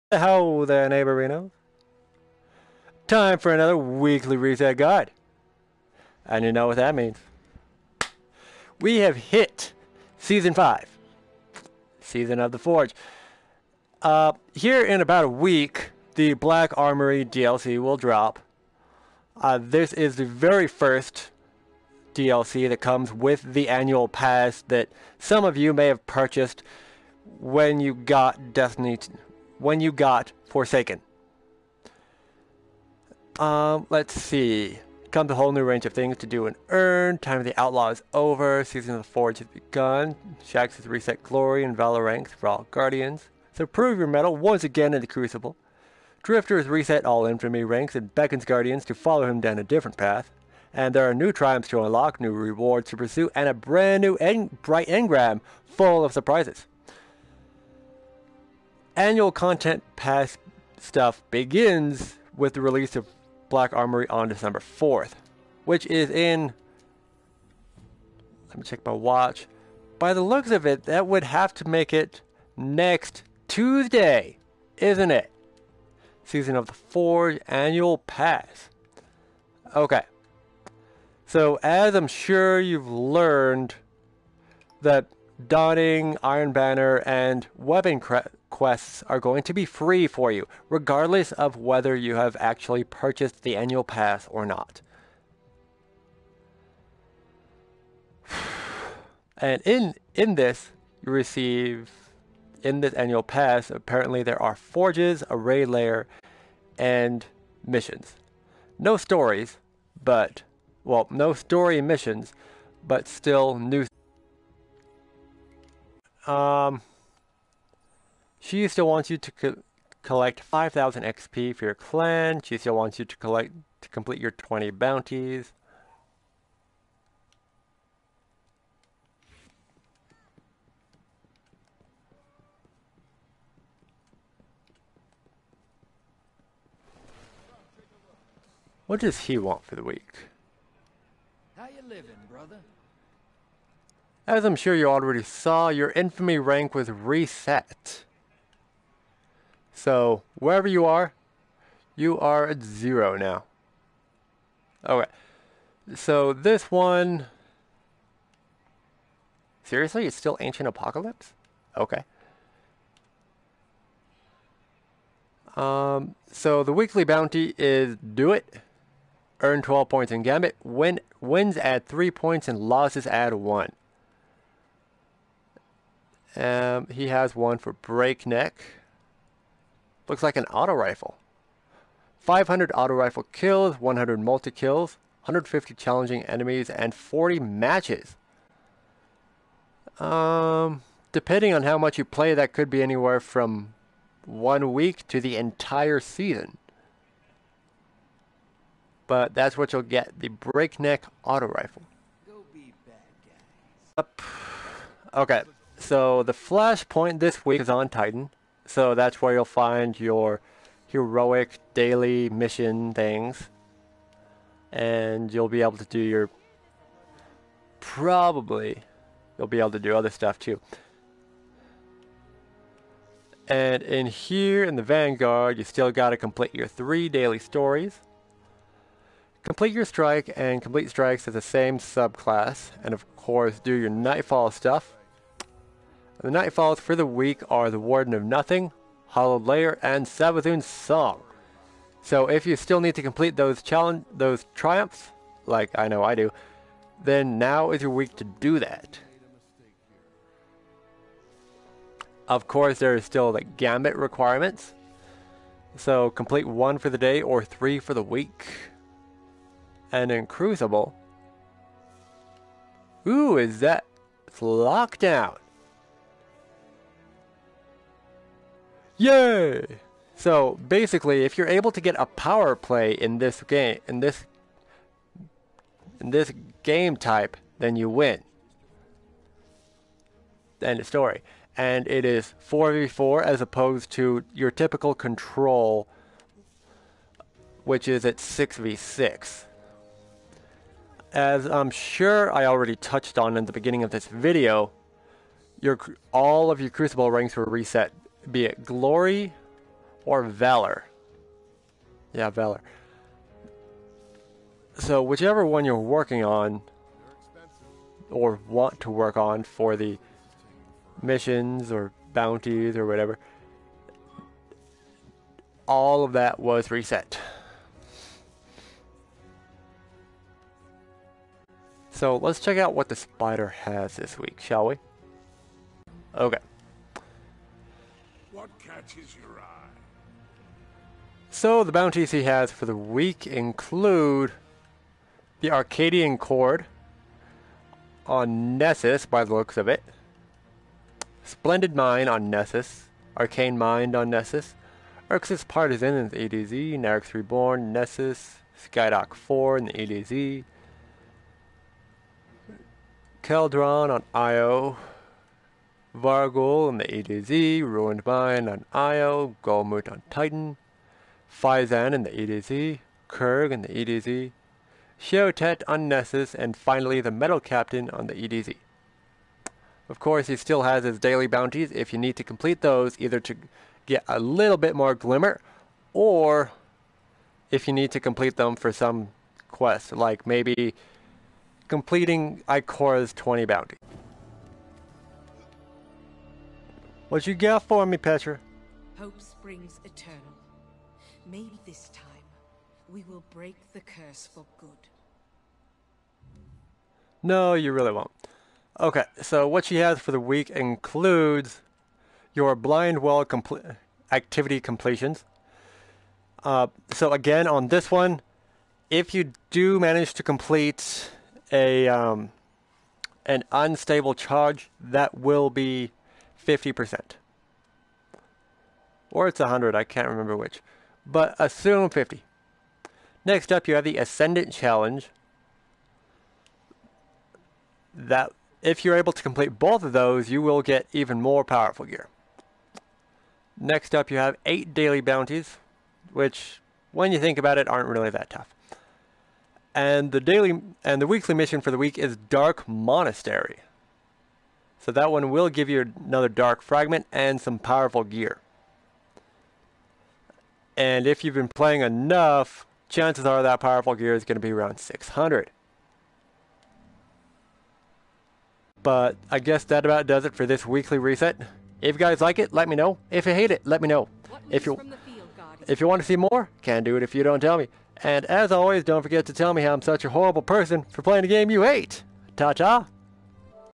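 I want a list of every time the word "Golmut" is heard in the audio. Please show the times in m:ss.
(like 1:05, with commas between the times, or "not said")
5:59.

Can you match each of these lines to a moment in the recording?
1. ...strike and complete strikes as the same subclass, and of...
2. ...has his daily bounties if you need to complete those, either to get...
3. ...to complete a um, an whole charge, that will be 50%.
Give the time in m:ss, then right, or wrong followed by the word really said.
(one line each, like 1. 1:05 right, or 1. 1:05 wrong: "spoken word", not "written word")
1. 3:49 right
2. 6:10 right
3. 6:50 wrong: "unstable", not "whole".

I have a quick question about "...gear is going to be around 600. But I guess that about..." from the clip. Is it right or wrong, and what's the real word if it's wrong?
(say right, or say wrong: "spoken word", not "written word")
right.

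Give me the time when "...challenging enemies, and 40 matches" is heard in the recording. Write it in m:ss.
3:05.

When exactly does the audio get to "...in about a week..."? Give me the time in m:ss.
0:14.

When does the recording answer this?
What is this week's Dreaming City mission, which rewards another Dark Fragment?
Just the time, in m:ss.
7:22.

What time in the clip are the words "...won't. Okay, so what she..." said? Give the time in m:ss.
6:37.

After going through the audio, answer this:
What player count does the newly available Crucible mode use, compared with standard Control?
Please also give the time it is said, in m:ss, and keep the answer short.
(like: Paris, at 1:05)
4v4, at 4:42.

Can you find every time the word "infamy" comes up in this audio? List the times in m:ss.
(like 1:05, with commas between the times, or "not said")
0:47, 2:25.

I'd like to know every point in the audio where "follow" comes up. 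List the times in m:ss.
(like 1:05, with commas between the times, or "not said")
0:48.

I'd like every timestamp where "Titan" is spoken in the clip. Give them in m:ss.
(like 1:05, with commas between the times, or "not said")
3:27, 6:00.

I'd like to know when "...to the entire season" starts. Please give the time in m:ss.
3:15.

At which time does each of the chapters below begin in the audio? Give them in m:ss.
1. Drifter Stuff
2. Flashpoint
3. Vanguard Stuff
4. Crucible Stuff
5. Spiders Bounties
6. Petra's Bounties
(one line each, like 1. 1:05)
1. 2:20
2. 3:28
3. 3:40
4. 4:19
5. 5:27
6. 6:24.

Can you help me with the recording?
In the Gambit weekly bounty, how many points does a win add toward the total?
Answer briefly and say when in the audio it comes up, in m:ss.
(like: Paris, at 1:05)
3, at 2:51.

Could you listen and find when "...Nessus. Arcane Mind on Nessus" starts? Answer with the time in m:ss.
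5:42.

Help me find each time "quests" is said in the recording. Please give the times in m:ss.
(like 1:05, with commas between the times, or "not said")
1:28, 6:19.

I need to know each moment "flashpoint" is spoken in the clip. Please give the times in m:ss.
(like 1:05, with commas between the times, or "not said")
3:26.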